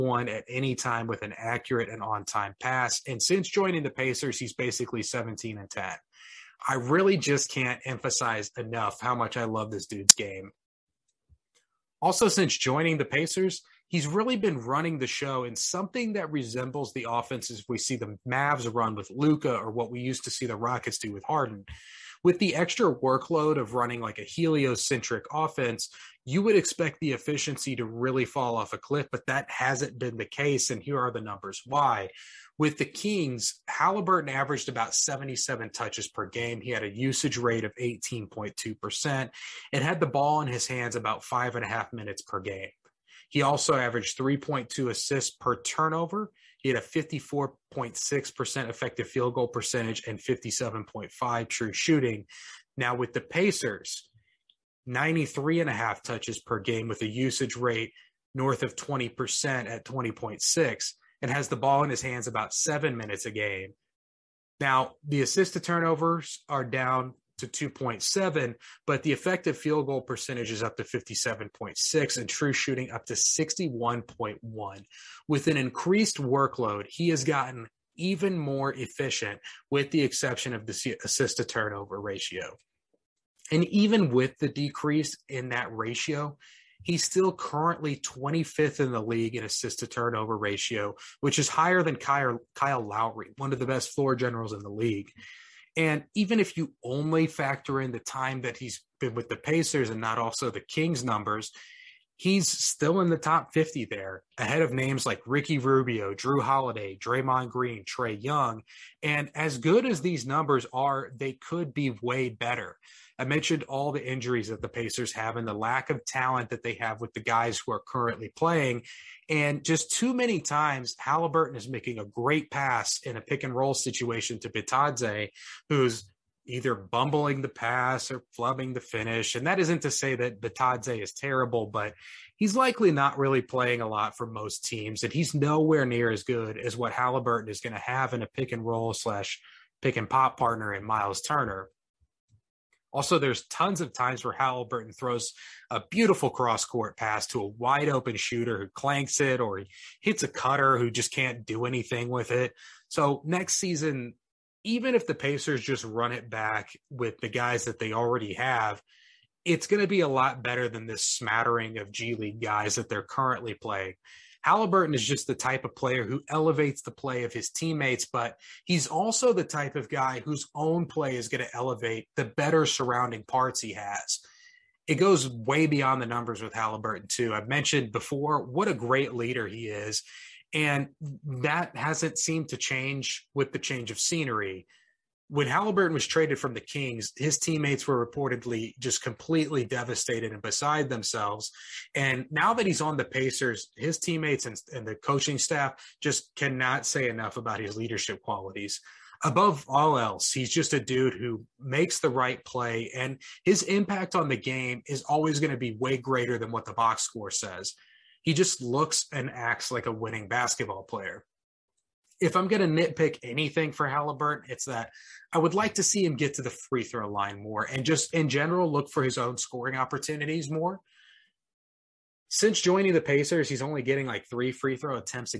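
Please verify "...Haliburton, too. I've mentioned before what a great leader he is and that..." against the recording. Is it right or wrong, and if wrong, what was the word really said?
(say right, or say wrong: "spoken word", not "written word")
right.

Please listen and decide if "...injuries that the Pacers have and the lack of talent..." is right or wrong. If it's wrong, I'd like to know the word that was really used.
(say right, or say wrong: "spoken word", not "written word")
right.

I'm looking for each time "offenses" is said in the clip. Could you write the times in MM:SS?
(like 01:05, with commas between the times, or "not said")
00:17, 00:25.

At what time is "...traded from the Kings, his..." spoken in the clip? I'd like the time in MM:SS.
03:06.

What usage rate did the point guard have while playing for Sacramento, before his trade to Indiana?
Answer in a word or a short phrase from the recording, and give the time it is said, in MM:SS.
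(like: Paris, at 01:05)
18.2%, at 00:37.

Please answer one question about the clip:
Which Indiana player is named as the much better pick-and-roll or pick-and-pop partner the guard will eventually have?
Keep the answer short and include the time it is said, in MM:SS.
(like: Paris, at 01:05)
Miles Turner, at 02:20.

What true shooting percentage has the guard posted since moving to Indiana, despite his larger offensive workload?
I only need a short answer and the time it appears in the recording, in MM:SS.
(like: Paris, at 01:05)
61.1, at 01:13.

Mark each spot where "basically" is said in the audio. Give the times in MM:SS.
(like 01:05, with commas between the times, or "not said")
00:04.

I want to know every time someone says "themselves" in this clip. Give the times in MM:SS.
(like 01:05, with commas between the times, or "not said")
03:10.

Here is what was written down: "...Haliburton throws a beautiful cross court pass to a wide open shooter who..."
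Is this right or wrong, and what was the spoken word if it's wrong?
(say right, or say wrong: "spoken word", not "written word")
right.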